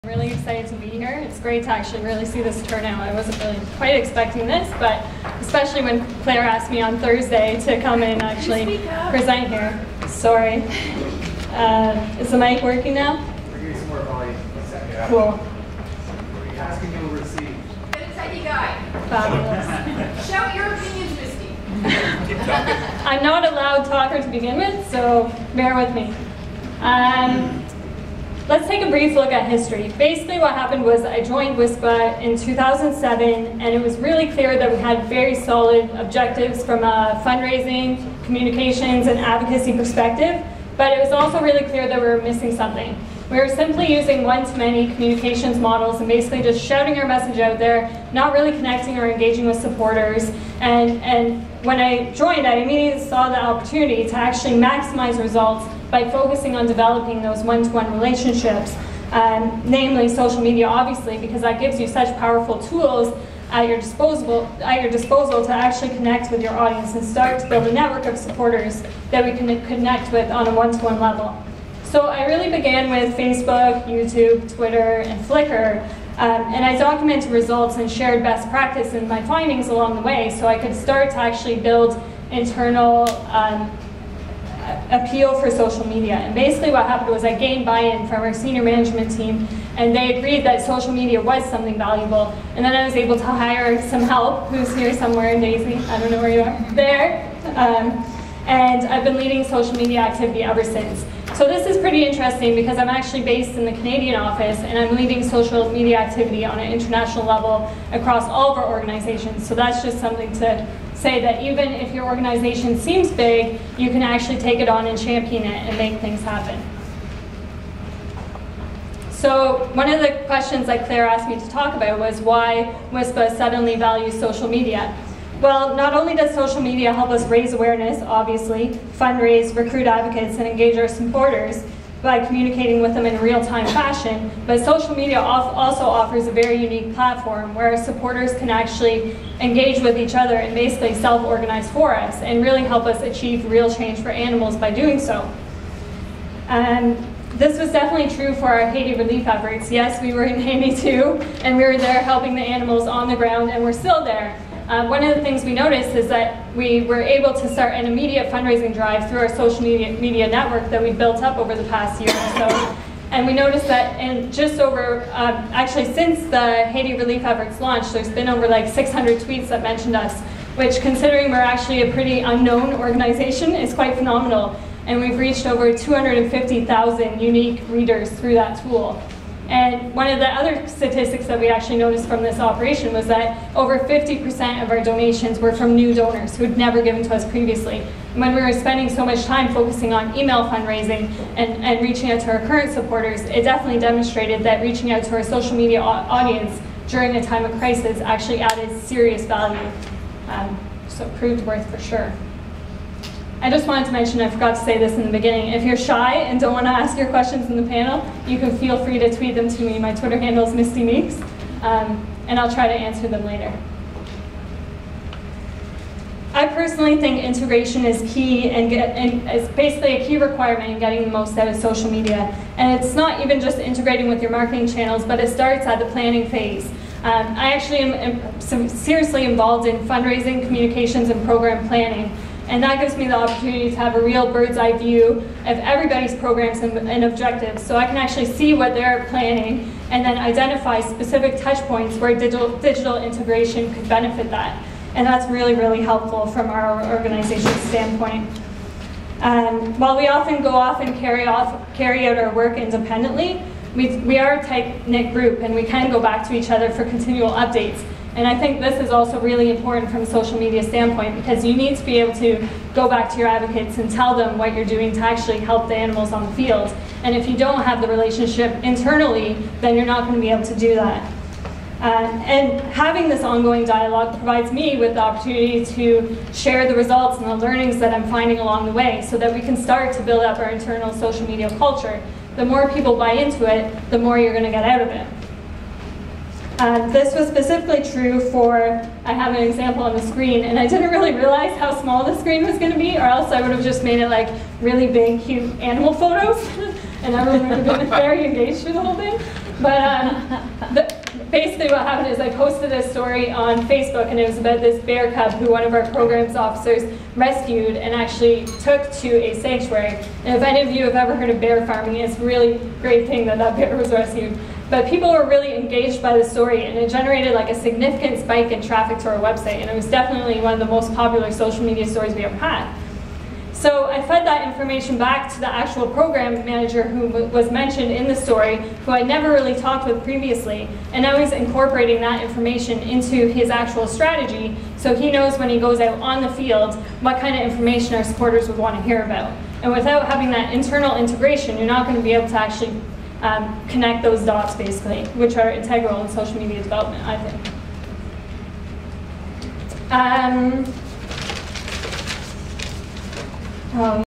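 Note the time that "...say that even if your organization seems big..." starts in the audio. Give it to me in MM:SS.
01:50.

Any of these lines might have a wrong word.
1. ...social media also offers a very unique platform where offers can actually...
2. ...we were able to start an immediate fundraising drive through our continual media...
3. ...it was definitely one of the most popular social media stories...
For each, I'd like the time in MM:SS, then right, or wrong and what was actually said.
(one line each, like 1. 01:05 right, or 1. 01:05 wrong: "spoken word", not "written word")
1. 02:14 wrong: "supporters", not "offers"
2. 02:36 wrong: "social", not "continual"
3. 05:19 right.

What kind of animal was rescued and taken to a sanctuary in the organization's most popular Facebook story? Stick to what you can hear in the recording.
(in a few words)
bear cub.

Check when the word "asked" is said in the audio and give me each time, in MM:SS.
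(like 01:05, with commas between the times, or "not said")
00:06, 02:01.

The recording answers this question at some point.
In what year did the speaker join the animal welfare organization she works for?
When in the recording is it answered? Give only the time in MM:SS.
00:32.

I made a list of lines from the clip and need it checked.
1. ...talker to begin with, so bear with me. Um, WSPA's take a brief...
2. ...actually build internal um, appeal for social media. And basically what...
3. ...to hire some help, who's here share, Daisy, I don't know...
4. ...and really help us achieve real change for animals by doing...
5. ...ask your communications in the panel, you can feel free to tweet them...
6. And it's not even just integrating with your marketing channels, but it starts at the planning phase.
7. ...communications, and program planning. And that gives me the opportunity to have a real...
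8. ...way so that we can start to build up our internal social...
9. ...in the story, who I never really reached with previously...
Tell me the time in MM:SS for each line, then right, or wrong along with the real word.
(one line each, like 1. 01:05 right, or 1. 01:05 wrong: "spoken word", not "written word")
1. 00:23 wrong: "Let", not "WSPA"
2. 01:21 right
3. 01:33 wrong: "somewhere", not "share"
4. 02:22 right
5. 03:26 wrong: "questions", not "communications"
6. 03:42 right
7. 03:50 right
8. 04:38 right
9. 05:27 wrong: "talked", not "reached".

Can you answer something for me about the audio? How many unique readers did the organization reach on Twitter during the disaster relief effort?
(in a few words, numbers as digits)
250,000.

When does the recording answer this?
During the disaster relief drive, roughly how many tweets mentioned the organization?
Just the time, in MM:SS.
02:48.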